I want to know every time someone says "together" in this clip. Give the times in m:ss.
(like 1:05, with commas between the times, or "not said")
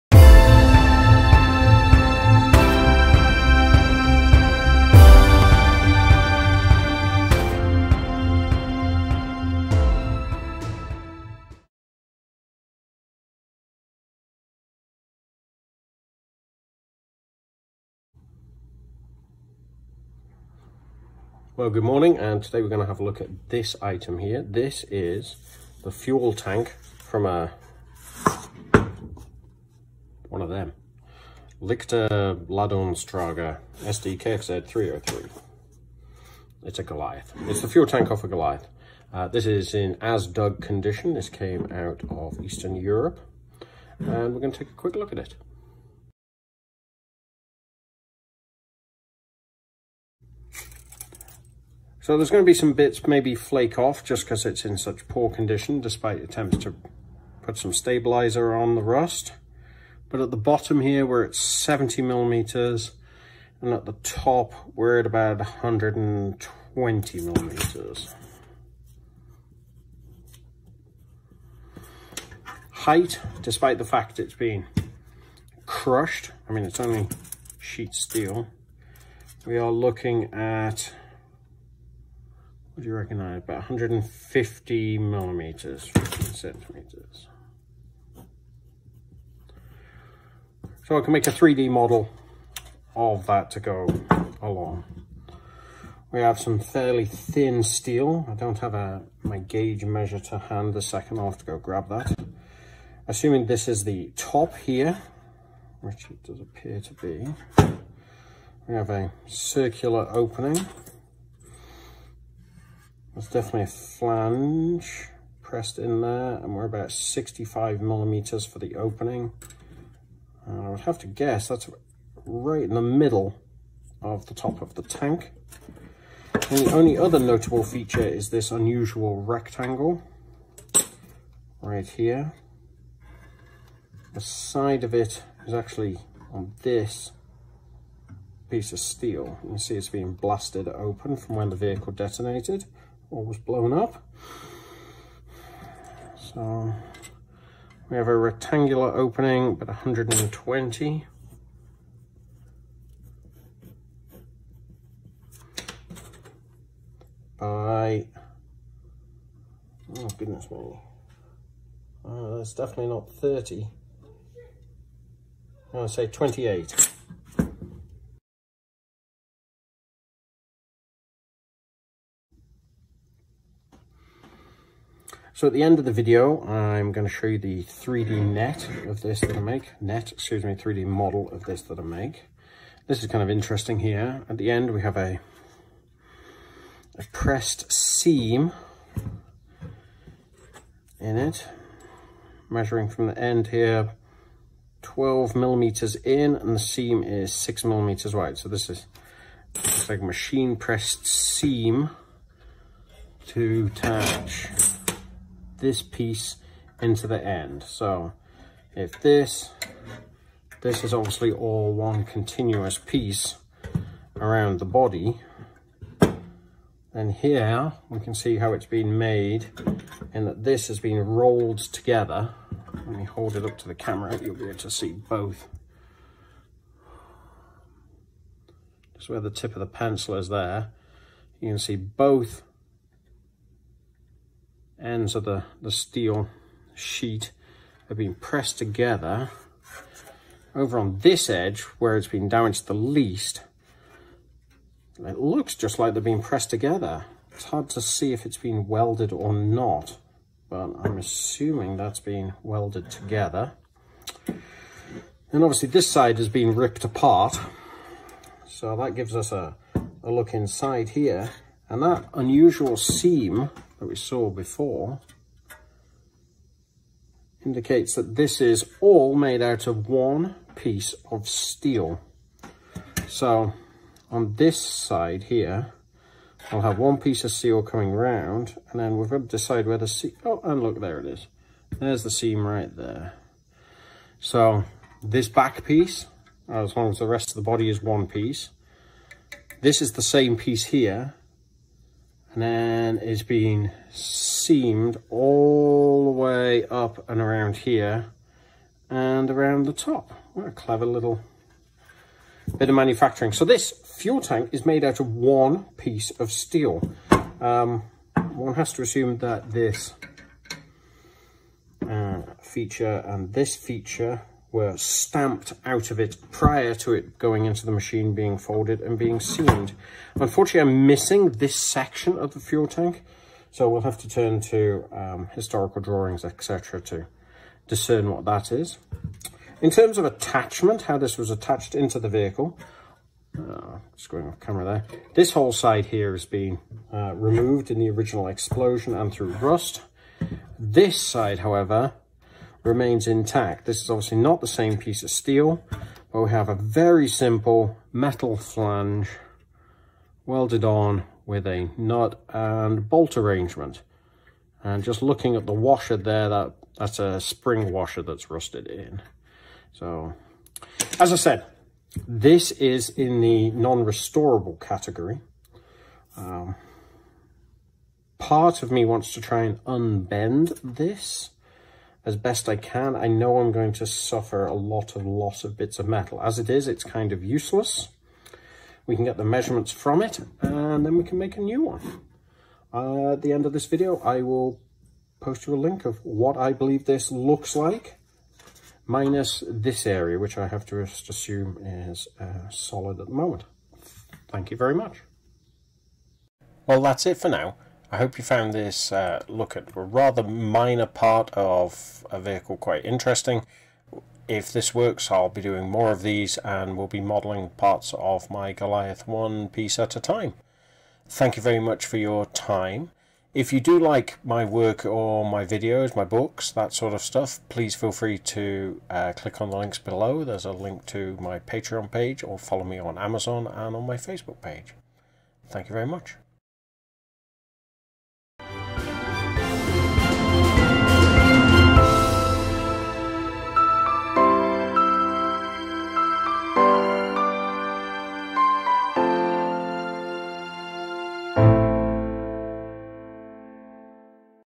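3:41, 3:58, 4:06, 4:12.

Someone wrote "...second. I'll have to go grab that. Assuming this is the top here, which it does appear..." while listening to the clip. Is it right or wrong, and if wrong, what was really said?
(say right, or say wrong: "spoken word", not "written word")
right.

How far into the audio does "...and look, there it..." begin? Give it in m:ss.
4:40.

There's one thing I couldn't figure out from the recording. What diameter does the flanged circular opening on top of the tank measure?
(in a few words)
65 millimeters.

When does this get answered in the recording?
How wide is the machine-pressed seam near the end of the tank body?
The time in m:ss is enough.
3:17.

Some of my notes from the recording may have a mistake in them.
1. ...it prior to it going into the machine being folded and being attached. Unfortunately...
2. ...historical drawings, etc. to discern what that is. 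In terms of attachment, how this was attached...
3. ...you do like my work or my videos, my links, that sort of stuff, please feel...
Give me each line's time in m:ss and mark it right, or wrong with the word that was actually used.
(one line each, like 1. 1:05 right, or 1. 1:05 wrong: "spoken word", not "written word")
1. 5:15 wrong: "seamed", not "attached"
2. 5:25 right
3. 6:53 wrong: "books", not "links".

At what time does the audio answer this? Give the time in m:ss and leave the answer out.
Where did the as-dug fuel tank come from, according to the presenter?
0:42.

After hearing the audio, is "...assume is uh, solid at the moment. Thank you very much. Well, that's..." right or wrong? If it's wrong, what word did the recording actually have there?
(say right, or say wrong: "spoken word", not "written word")
right.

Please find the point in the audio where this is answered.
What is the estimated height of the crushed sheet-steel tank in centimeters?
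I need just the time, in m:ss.
1:25.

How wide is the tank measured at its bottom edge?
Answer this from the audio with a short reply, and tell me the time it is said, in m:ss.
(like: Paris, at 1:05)
70 millimeters, at 1:01.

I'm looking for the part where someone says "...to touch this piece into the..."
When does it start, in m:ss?
3:23.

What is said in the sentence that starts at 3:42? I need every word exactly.
Let me hold it up to the camera, you'll be able to see both.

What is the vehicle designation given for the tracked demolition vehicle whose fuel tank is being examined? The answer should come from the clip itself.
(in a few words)
SDKZ 303.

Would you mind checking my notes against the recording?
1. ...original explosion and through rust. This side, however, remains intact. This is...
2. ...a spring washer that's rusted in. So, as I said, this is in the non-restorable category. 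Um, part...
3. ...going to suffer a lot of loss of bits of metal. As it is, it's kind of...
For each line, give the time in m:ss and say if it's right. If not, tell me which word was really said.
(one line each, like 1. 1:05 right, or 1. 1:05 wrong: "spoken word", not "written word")
1. 5:37 right
2. 5:56 right
3. 6:13 right.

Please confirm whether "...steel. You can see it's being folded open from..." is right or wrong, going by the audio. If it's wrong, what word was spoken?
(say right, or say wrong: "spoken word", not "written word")
wrong: "blasted", not "folded".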